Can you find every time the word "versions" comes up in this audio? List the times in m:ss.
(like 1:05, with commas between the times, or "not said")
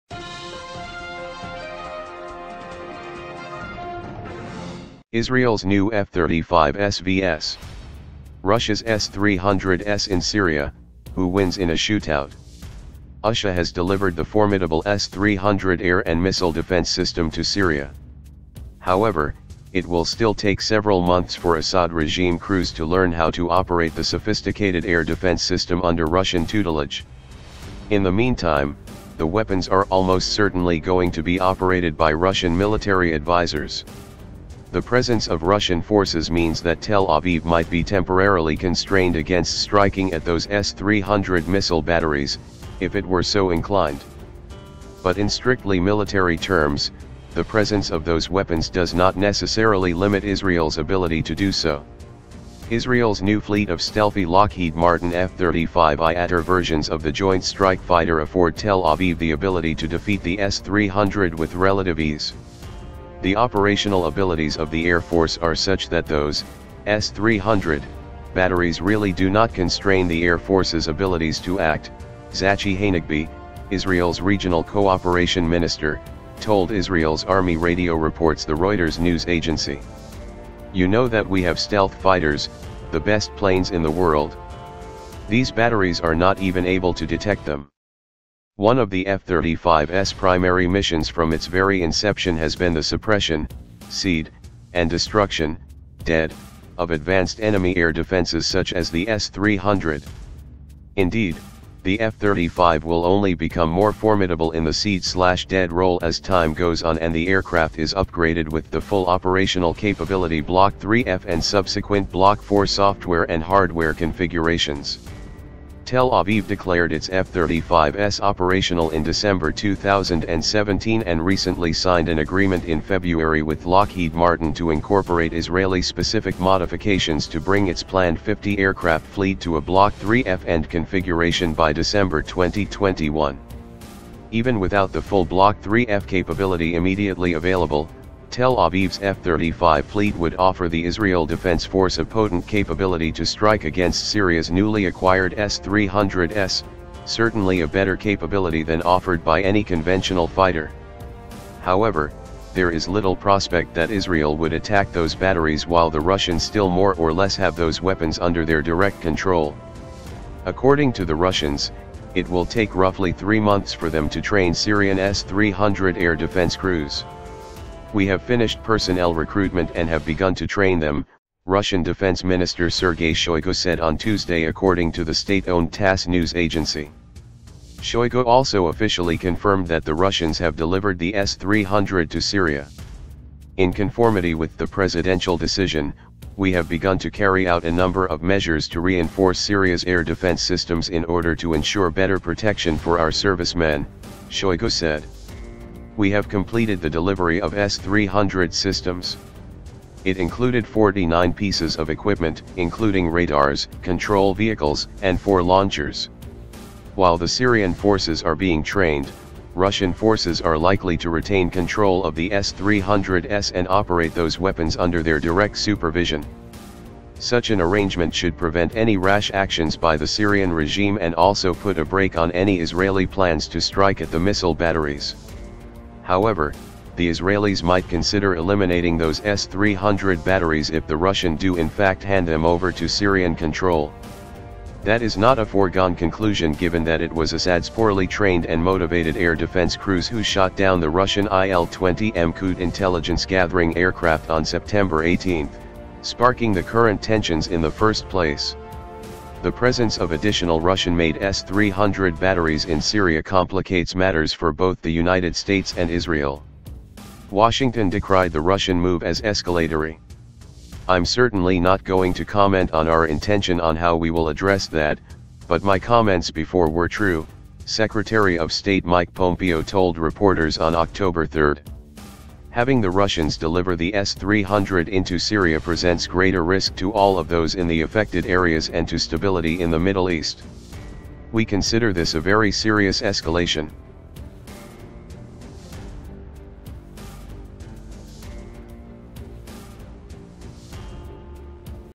0:56.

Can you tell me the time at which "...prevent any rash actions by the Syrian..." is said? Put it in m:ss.
3:38.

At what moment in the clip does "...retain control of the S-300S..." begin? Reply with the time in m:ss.
3:31.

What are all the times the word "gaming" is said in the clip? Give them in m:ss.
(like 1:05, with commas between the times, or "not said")
not said.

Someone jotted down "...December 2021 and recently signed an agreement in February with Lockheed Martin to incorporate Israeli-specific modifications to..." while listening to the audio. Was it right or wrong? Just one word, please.
wrong.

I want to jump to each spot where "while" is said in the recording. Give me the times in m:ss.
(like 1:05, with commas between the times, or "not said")
2:35, 3:26.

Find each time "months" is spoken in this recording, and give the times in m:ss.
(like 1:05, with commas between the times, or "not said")
0:21, 2:43.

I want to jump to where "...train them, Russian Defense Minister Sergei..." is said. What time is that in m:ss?
2:50.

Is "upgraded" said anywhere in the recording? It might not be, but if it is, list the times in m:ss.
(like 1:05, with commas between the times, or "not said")
1:47.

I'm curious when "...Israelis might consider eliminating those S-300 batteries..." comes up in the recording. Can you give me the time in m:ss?
3:47.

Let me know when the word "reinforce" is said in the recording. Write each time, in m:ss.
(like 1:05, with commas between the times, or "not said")
3:08.